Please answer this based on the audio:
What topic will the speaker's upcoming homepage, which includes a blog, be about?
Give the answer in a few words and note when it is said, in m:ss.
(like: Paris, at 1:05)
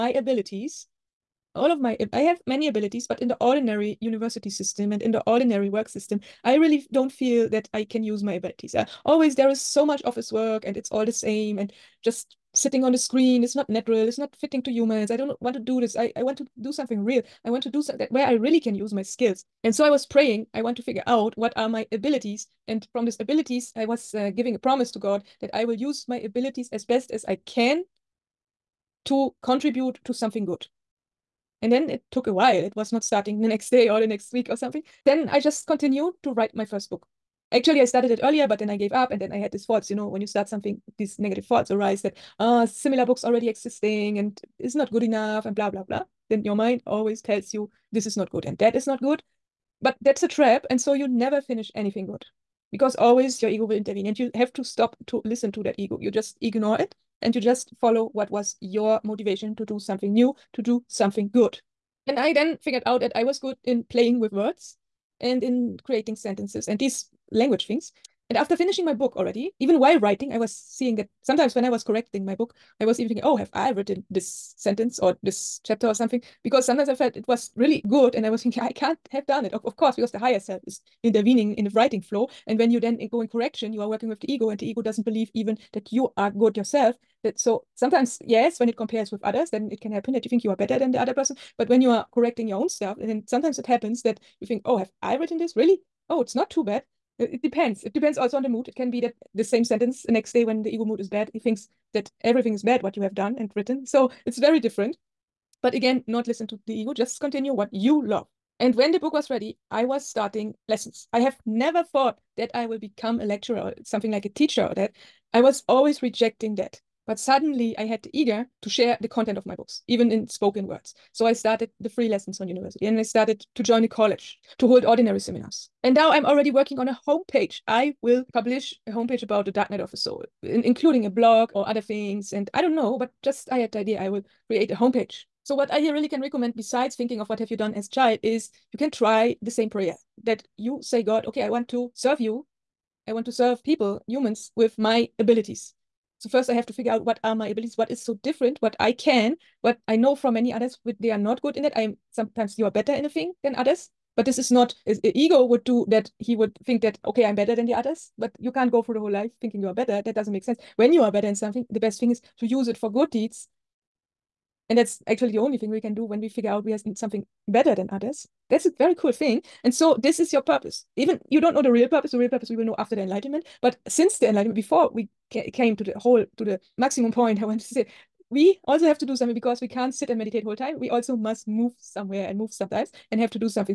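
dark night of the soul, at 2:09.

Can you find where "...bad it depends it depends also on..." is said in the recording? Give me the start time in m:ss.
1:36.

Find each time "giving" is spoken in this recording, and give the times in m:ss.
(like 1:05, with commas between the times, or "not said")
0:24.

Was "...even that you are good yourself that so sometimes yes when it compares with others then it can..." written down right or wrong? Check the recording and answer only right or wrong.
right.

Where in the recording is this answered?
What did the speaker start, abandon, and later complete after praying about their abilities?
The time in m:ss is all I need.
0:36.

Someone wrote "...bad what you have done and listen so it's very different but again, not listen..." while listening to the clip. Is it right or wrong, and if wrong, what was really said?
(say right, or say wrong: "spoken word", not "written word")
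wrong: "written", not "listen".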